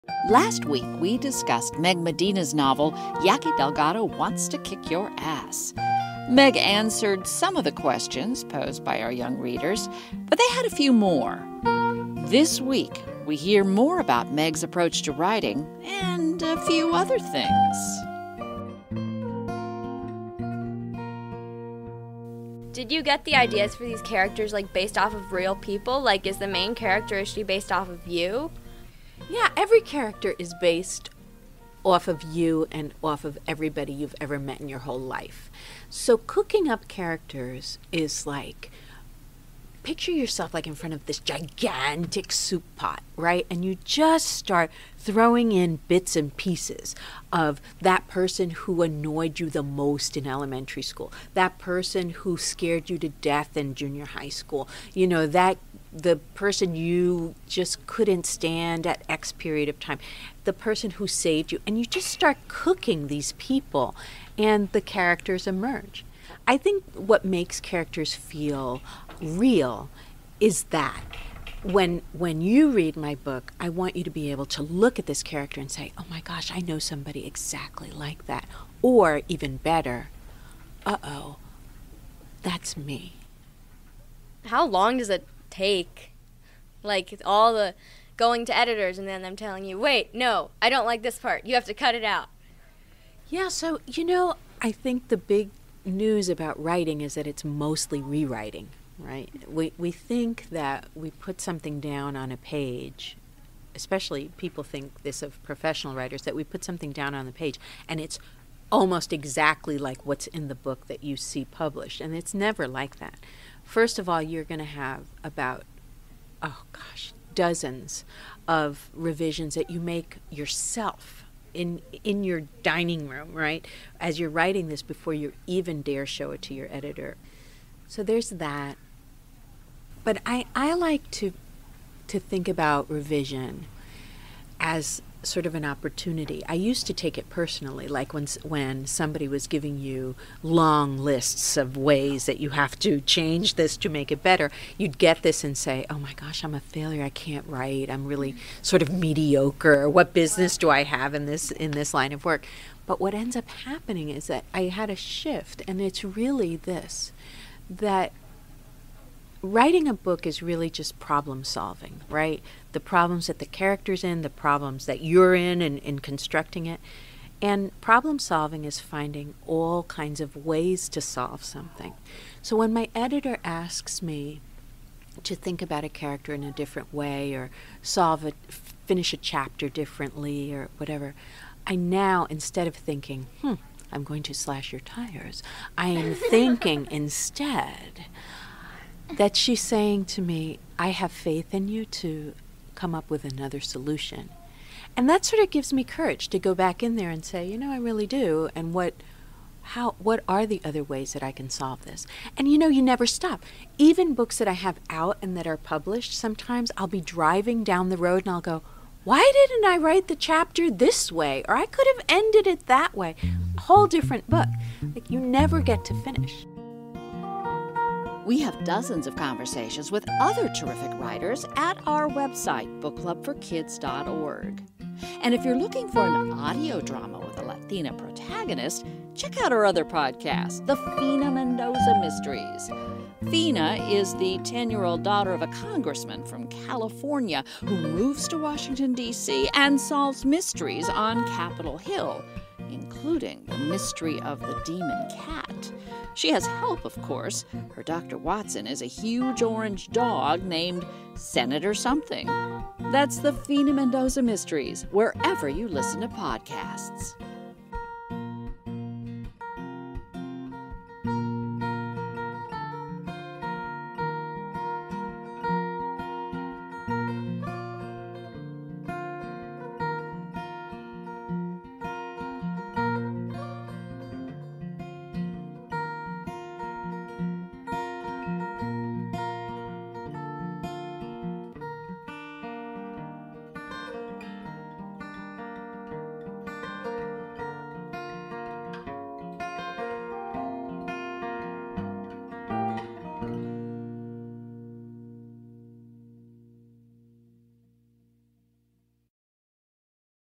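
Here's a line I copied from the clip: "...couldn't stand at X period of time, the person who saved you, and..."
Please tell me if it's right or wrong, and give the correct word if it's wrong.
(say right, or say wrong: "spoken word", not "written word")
right.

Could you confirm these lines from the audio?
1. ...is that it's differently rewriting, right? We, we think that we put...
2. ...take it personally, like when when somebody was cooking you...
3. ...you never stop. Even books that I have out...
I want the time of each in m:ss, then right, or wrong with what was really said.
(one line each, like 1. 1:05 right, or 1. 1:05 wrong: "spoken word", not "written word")
1. 1:37 wrong: "mostly", not "differently"
2. 2:16 wrong: "giving", not "cooking"
3. 3:22 right.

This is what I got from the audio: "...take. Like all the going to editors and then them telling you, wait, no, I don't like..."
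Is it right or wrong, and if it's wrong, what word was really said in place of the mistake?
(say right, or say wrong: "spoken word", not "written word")
right.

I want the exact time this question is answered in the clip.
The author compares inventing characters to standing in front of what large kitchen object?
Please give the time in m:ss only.
0:42.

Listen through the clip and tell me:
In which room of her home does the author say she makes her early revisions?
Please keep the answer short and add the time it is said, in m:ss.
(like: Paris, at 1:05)
dining room, at 2:02.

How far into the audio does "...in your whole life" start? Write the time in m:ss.
0:34.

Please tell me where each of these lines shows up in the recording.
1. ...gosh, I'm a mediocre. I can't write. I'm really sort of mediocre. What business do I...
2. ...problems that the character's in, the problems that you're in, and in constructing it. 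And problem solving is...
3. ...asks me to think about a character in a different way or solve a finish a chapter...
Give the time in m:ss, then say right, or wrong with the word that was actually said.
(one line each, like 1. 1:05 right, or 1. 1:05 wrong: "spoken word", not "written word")
1. 2:26 wrong: "failure", not "mediocre"
2. 2:42 right
3. 2:53 right.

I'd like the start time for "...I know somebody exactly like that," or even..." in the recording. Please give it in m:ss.
1:16.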